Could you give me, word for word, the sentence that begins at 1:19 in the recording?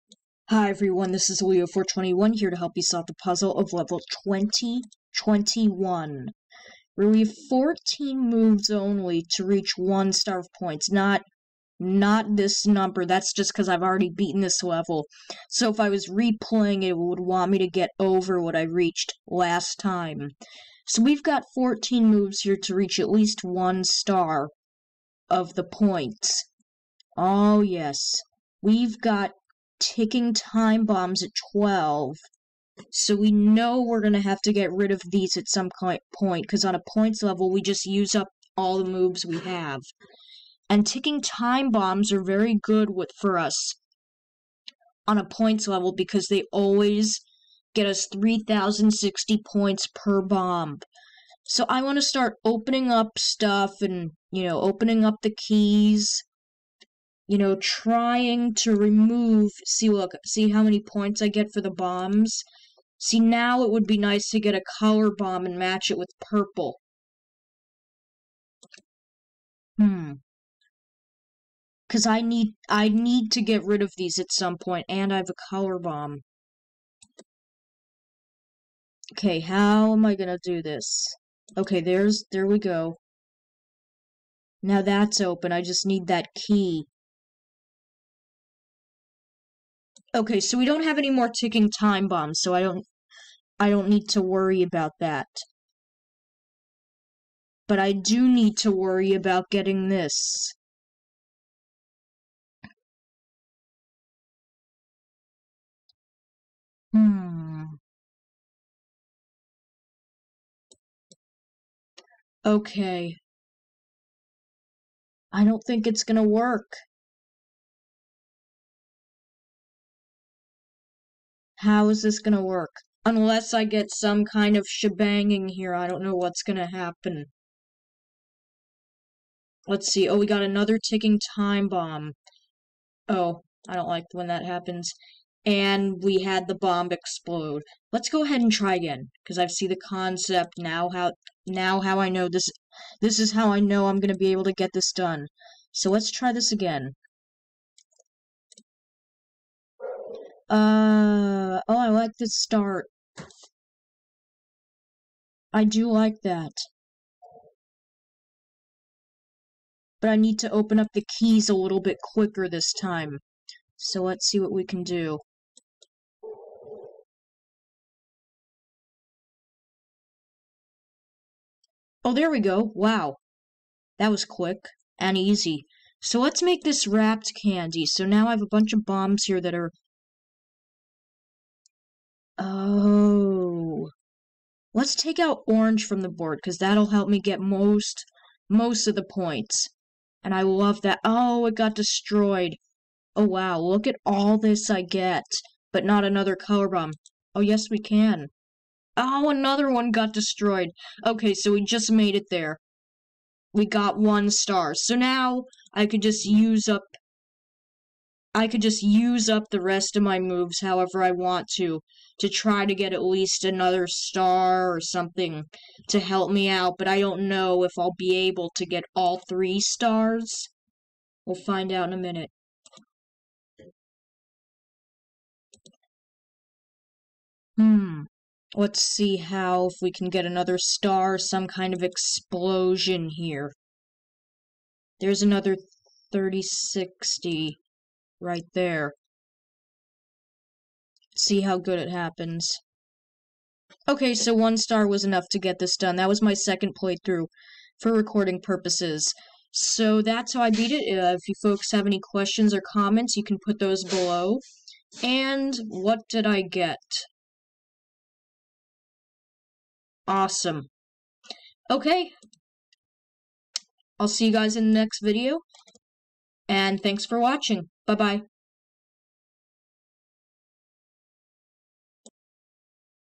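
Okay, how am I gonna do this?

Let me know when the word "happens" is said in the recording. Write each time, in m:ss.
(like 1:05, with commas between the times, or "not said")
2:06, 2:14, 4:01.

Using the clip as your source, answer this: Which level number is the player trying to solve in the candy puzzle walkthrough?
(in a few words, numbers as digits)
2021.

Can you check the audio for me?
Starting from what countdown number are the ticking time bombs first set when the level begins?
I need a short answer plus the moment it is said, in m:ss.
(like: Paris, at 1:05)
12, at 0:31.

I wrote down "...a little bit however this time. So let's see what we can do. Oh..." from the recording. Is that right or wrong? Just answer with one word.
wrong.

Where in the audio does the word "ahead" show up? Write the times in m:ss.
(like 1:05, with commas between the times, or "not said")
2:18.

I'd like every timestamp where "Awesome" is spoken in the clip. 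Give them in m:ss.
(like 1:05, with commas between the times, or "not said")
4:20.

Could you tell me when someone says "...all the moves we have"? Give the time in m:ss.
0:38.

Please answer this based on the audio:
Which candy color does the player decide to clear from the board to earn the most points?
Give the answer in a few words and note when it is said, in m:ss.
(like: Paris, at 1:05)
Orange, at 3:05.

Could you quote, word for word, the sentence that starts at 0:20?
So we've got 14 moves here to reach at least one star of the points.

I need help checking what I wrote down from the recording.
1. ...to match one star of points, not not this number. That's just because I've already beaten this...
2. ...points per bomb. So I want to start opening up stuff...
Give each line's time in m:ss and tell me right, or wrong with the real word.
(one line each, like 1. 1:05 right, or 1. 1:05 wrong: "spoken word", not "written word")
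1. 0:09 wrong: "reach", not "match"
2. 0:49 right.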